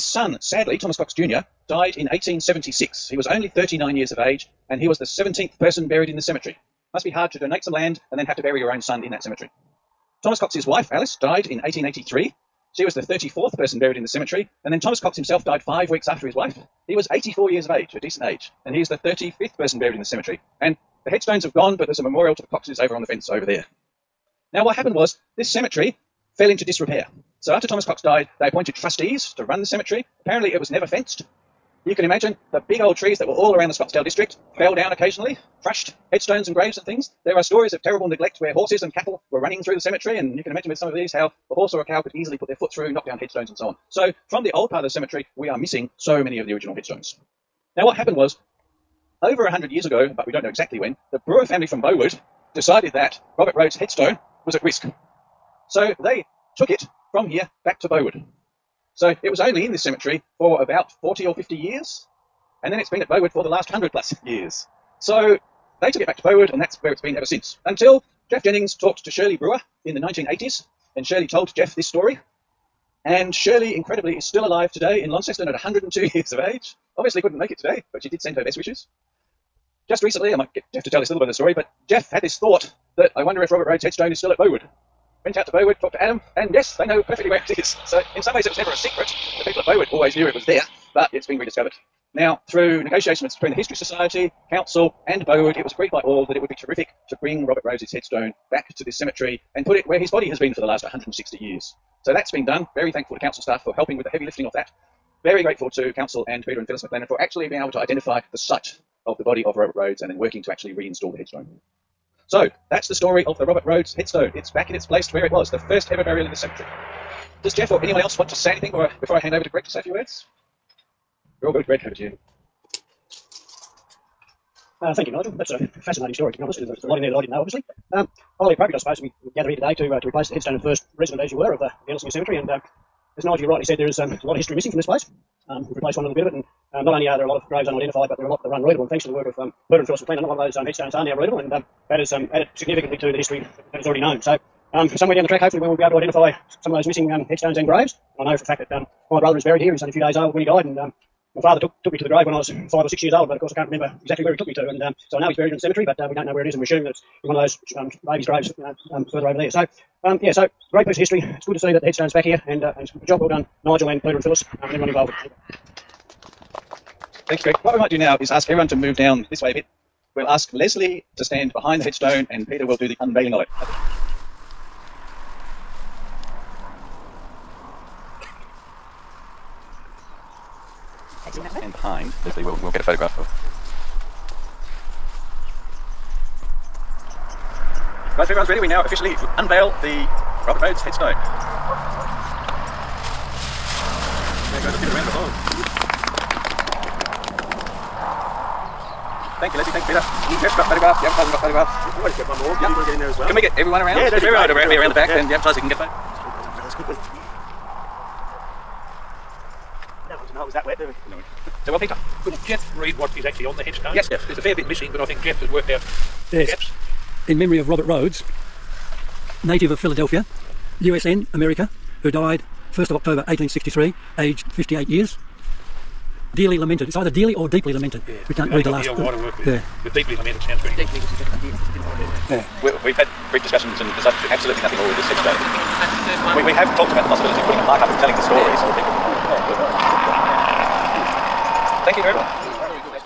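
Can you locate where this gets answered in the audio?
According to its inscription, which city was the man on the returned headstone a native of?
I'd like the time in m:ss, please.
3:39.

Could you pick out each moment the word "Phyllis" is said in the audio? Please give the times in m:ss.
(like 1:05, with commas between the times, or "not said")
1:46, 2:19, 2:44.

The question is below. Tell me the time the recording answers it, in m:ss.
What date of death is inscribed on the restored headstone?
3:42.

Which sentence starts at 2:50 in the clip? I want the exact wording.
We'll ask Leslie to stand behind the headstone and Peter will do the unveiling of it.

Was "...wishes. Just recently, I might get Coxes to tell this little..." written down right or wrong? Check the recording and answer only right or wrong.
wrong.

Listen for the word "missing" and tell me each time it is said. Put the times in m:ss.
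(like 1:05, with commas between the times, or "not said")
0:45, 2:14, 2:26, 3:34.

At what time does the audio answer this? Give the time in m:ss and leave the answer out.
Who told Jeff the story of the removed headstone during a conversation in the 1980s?
1:09.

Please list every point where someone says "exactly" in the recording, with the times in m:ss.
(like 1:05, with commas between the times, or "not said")
0:50, 2:34.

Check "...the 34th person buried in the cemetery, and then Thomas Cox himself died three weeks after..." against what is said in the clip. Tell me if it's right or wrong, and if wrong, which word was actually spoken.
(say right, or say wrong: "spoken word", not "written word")
wrong: "five", not "three".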